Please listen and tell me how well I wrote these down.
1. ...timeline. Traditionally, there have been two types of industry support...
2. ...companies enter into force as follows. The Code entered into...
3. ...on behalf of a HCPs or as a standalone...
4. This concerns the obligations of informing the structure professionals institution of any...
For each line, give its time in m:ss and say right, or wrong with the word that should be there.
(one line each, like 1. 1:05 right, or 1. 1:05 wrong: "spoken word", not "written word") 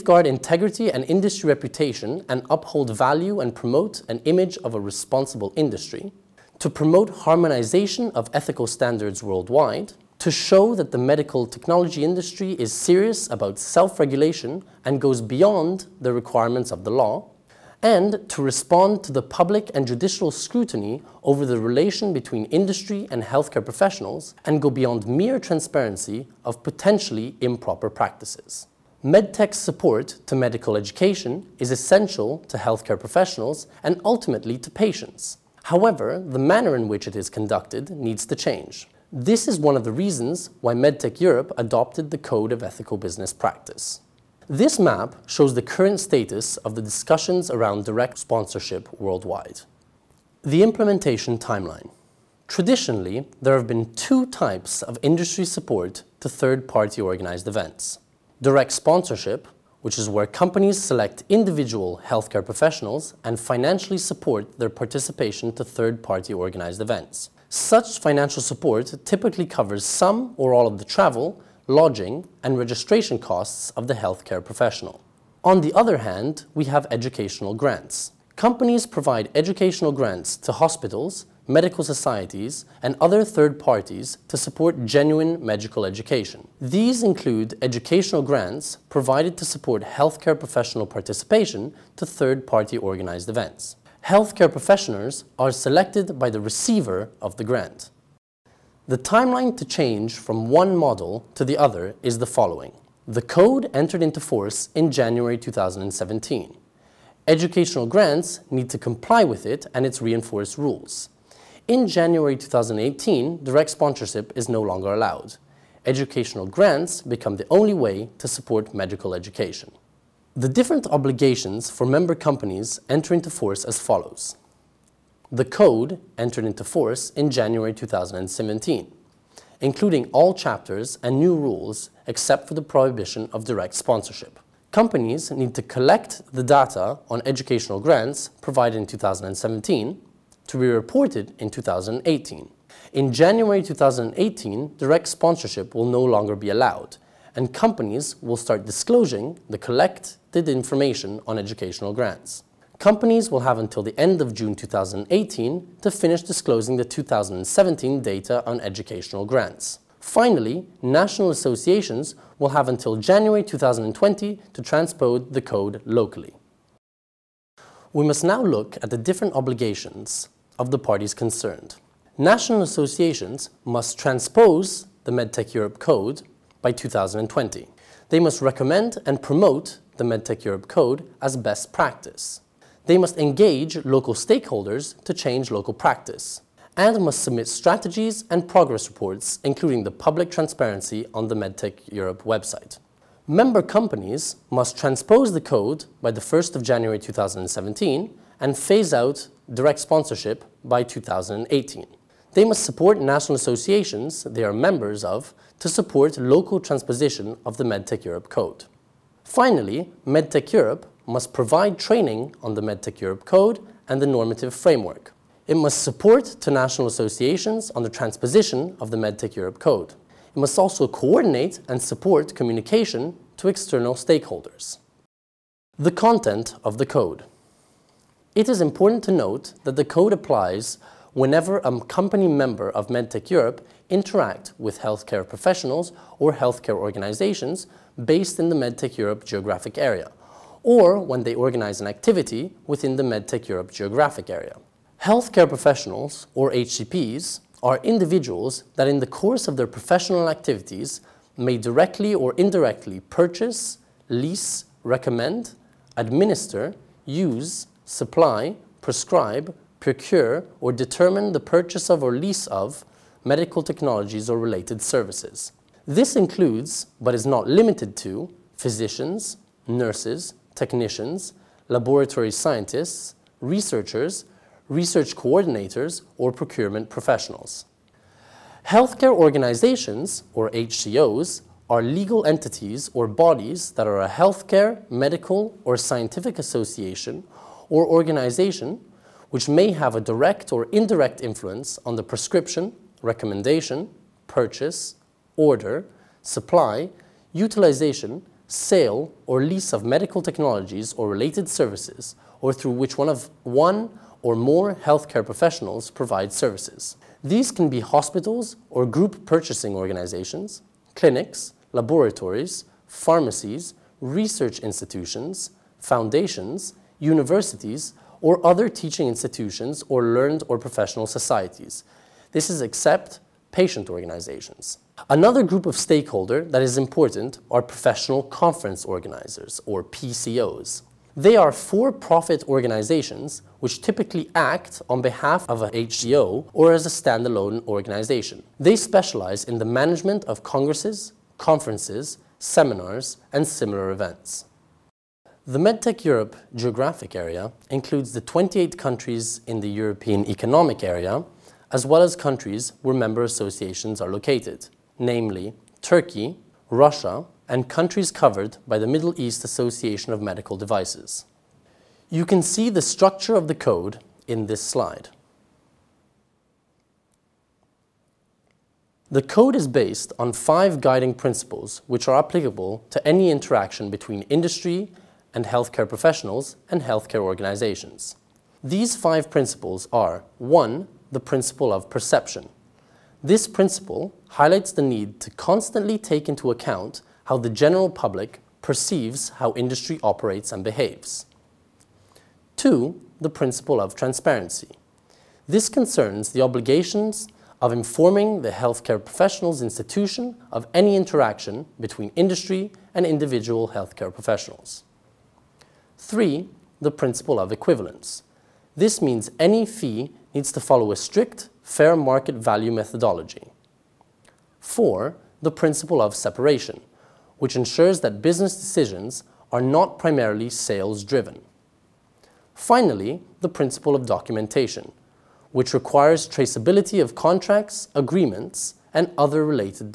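1. 0:51 right
2. 2:02 right
3. 5:34 wrong: "HCO", not "HCPs"
4. 6:35 wrong: "healthcare", not "structure".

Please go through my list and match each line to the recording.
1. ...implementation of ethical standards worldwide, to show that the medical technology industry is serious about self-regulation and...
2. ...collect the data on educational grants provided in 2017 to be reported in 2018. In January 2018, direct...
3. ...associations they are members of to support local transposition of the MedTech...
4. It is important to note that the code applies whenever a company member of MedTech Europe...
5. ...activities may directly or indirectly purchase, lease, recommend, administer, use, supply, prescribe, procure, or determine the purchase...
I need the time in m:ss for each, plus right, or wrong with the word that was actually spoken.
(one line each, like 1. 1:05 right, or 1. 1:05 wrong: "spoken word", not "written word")
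1. 0:07 wrong: "harmonization", not "implementation"
2. 2:15 right
3. 3:23 right
4. 3:48 right
5. 4:10 right.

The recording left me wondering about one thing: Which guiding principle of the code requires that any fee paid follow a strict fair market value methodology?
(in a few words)
Principle of equivalence.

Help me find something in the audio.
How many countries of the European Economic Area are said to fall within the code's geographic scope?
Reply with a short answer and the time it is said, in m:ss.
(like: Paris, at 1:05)
28, at 5:48.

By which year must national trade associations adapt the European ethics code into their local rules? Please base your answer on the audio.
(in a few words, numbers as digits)
2020.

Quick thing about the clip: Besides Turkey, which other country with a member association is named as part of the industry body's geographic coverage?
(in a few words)
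Russia.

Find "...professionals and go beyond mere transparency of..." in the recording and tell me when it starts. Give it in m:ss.
0:23.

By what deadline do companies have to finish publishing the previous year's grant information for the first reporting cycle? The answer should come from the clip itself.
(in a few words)
End of June 2018.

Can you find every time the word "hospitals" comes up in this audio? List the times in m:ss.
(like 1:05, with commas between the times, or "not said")
1:20, 5:07.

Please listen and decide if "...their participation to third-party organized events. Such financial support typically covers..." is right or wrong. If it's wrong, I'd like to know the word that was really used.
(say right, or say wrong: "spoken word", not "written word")
right.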